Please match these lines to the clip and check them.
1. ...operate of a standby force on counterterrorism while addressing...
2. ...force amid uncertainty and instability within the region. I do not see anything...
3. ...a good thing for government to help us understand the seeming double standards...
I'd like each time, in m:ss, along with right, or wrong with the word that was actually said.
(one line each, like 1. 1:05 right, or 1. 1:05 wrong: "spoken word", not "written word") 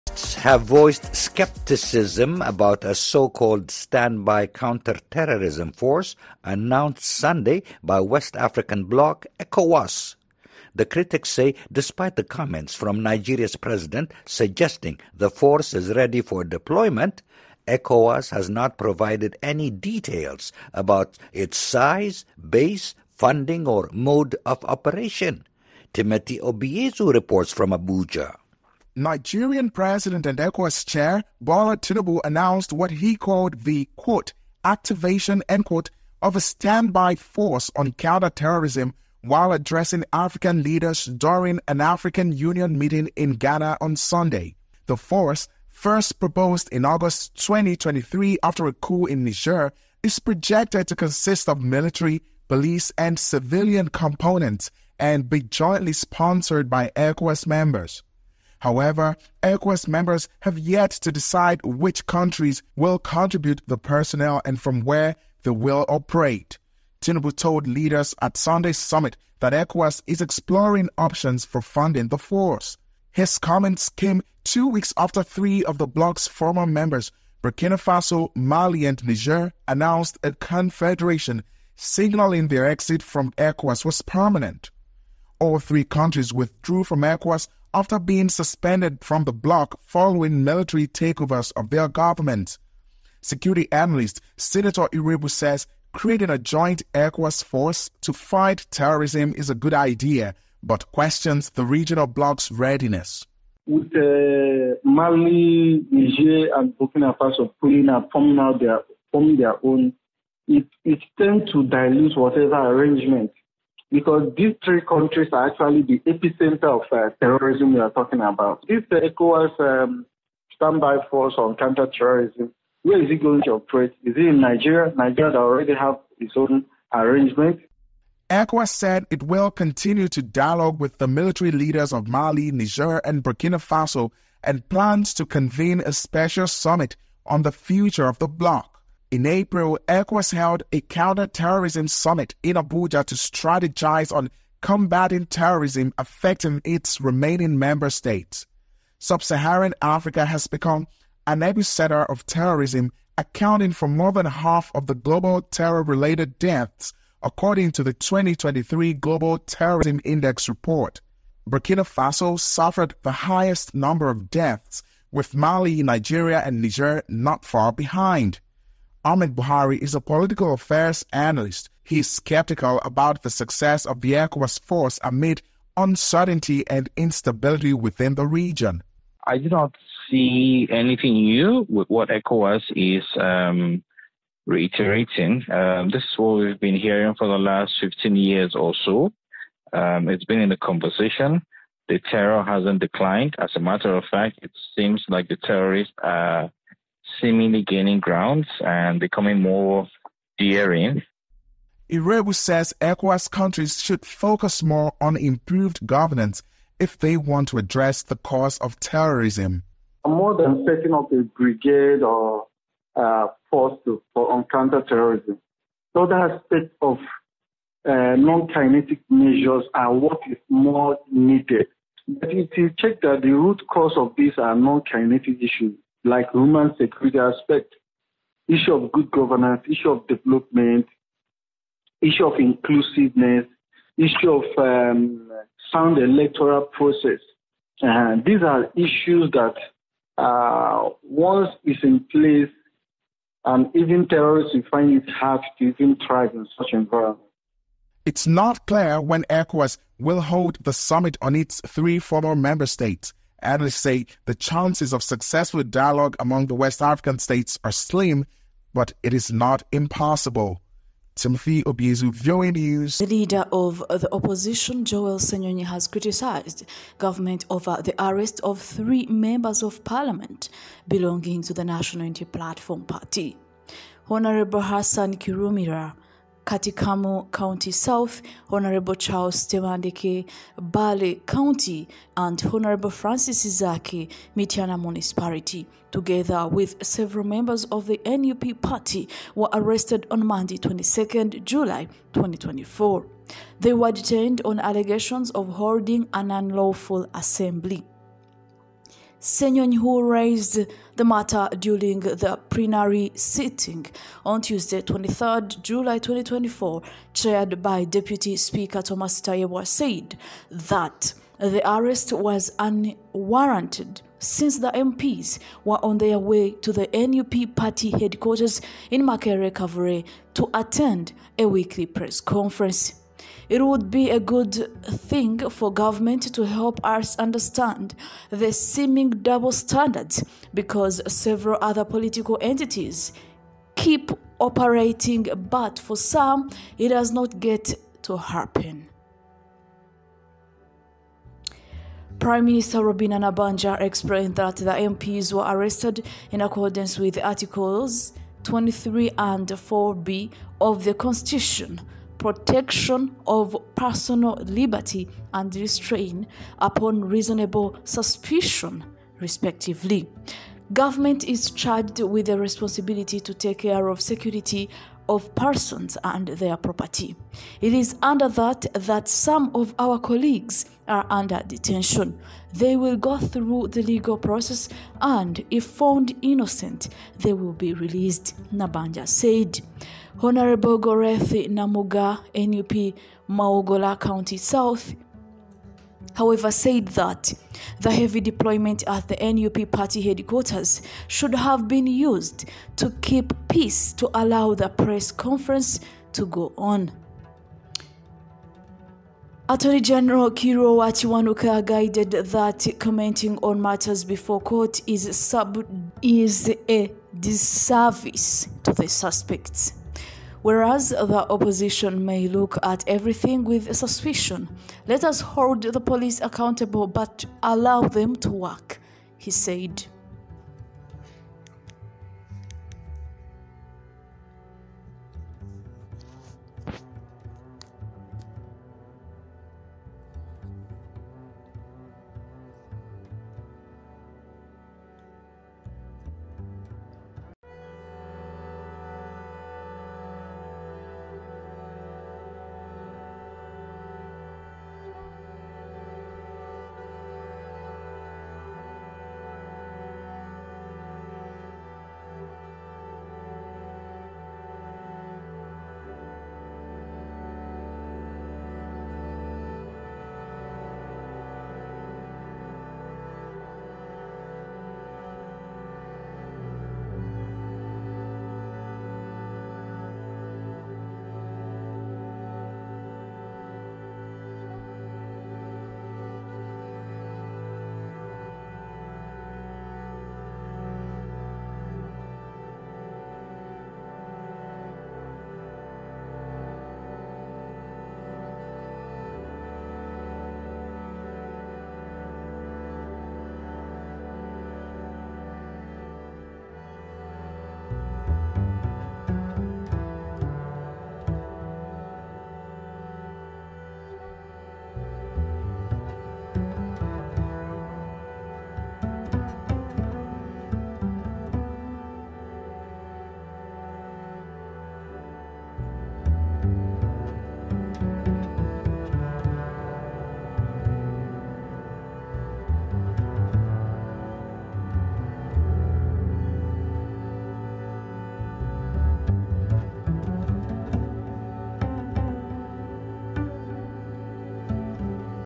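1. 0:35 wrong: "quote", not "operate"
2. 2:54 right
3. 5:24 right.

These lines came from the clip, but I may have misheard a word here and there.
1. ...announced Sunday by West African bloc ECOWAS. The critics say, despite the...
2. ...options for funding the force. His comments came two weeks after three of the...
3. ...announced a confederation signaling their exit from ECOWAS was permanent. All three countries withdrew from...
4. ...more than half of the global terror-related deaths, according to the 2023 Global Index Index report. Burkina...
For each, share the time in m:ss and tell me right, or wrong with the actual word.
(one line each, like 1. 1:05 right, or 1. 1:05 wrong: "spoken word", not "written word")
1. 0:06 right
2. 1:10 right
3. 1:19 right
4. 2:33 wrong: "Terrorism", not "Index".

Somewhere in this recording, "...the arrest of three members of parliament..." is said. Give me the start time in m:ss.
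4:27.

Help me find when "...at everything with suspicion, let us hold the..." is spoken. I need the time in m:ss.
6:52.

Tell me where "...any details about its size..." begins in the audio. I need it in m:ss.
0:19.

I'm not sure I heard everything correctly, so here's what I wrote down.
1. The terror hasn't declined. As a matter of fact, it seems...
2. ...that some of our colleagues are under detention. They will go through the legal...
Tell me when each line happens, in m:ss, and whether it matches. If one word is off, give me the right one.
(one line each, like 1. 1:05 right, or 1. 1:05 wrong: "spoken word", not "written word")
1. 3:11 right
2. 6:08 right.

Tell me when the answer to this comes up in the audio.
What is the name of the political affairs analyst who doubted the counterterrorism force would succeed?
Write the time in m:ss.
2:49.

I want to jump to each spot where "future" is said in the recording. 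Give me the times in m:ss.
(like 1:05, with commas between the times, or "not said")
2:17.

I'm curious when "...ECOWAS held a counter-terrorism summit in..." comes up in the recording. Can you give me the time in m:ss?
2:19.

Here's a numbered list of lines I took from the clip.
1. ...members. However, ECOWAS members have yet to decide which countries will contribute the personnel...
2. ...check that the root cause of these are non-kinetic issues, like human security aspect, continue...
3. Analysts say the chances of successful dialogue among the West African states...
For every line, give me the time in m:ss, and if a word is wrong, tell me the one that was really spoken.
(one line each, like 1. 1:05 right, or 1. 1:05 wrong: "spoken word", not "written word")
1. 0:57 right
2. 3:42 wrong: "issue", not "continue"
3. 4:13 right.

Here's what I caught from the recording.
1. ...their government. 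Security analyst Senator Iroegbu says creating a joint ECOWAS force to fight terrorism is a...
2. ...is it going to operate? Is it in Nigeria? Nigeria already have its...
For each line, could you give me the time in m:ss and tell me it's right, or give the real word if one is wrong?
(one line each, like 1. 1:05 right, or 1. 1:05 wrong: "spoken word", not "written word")
1. 1:31 right
2. 2:03 right.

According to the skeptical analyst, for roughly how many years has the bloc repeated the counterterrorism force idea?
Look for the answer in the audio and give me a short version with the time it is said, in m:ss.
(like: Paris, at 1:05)
15 years, at 3:07.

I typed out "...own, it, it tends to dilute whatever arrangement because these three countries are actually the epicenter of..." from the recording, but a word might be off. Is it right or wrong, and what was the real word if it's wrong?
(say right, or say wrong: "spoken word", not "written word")
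right.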